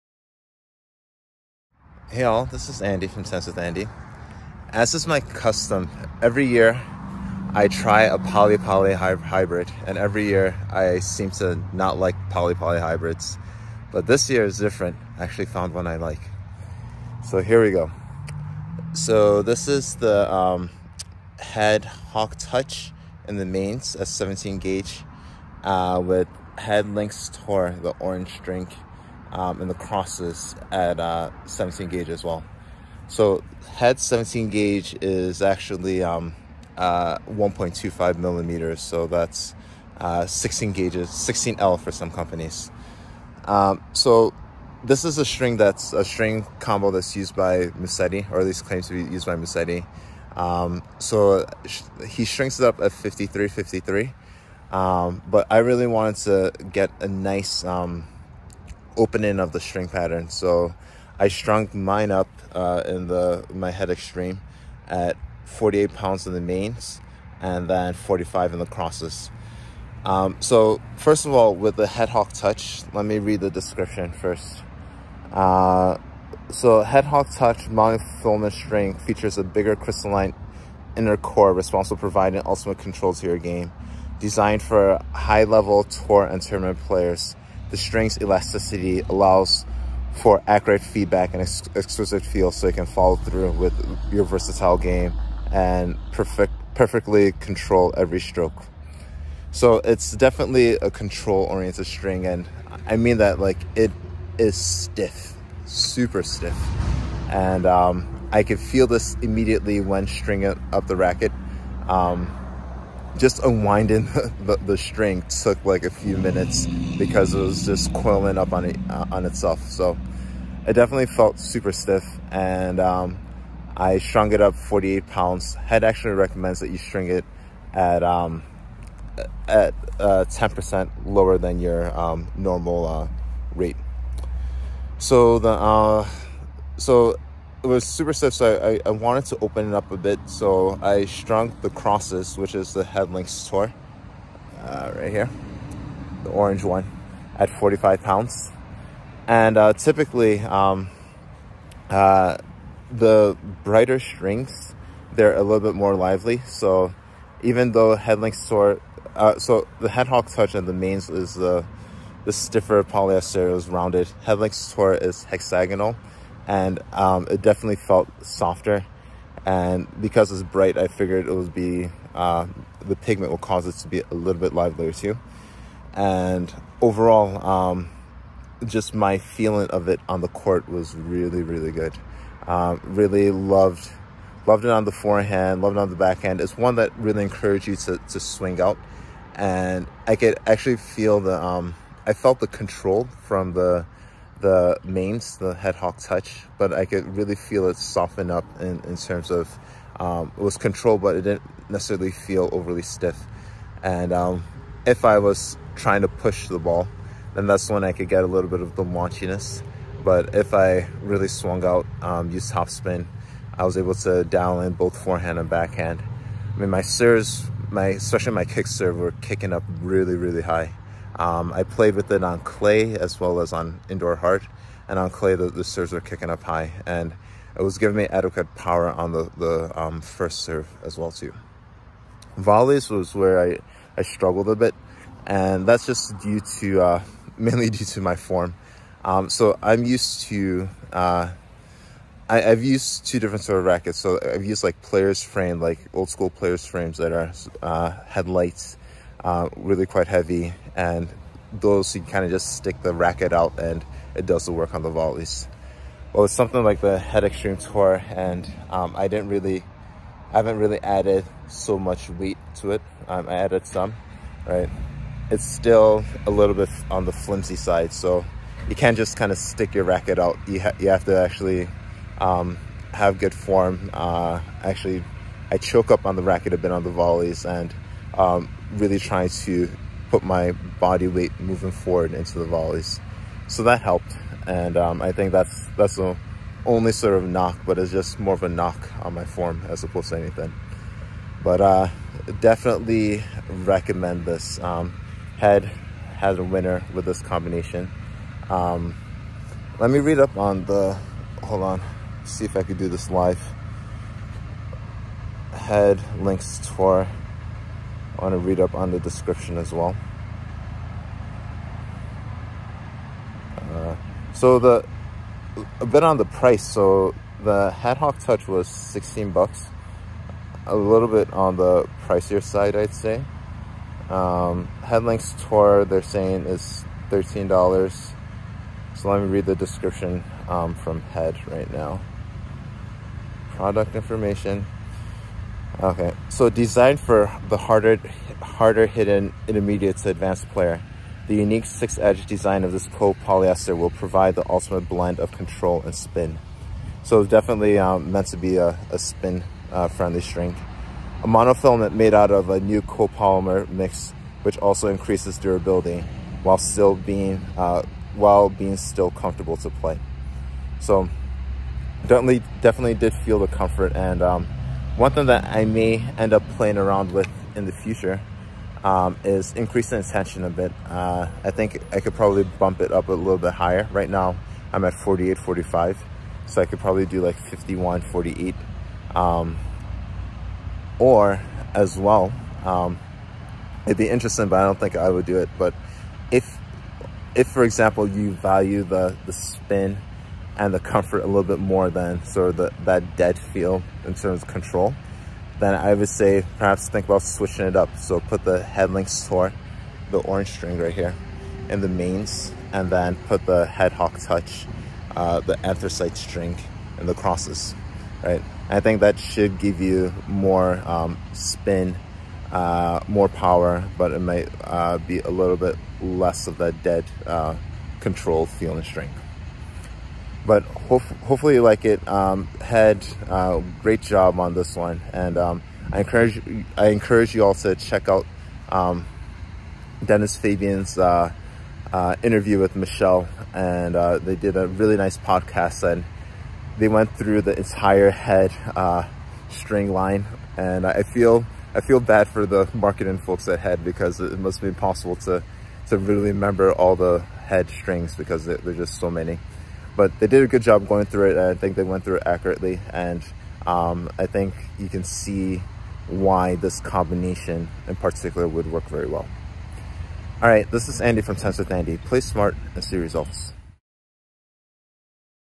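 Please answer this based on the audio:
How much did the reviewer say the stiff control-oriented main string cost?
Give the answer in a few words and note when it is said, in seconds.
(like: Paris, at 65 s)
$16, at 318 s.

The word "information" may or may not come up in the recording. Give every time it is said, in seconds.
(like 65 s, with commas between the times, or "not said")
333 s.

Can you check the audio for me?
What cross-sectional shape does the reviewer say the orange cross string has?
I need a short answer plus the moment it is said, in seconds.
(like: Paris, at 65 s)
hexagonal, at 165 s.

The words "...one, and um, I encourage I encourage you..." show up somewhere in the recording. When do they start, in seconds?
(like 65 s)
424 s.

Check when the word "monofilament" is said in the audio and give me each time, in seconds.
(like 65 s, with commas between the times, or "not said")
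77 s, 351 s.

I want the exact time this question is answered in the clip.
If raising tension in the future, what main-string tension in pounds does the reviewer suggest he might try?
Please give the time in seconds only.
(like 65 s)
377 s.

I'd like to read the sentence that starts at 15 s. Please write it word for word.
I actually found one I like.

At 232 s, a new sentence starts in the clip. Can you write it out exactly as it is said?
Volleys was where I I struggled a bit.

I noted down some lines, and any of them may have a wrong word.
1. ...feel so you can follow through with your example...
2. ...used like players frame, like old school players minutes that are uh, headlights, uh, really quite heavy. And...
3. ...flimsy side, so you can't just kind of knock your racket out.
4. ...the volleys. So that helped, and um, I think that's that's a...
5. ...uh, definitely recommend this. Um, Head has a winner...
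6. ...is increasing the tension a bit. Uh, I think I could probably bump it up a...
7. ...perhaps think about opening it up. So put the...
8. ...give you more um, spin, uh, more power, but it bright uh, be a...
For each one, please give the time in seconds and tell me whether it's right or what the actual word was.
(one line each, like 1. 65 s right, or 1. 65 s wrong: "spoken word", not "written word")
1. 92 s wrong: "versatile", not "example"
2. 244 s wrong: "frames", not "minutes"
3. 267 s wrong: "stick", not "knock"
4. 282 s right
5. 291 s right
6. 369 s right
7. 396 s wrong: "switching", not "opening"
8. 409 s wrong: "might", not "bright".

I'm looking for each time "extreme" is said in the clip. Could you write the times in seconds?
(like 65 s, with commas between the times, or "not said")
63 s, 257 s.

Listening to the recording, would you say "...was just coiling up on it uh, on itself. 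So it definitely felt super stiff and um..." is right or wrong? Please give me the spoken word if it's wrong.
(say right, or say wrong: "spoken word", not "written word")
right.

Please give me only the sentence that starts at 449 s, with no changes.
But they did a good job going through it.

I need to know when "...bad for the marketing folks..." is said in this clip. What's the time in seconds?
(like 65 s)
441 s.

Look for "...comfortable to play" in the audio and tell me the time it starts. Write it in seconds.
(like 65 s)
359 s.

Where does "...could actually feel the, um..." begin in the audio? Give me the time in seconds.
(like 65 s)
190 s.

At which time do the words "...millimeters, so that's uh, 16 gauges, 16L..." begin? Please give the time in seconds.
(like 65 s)
38 s.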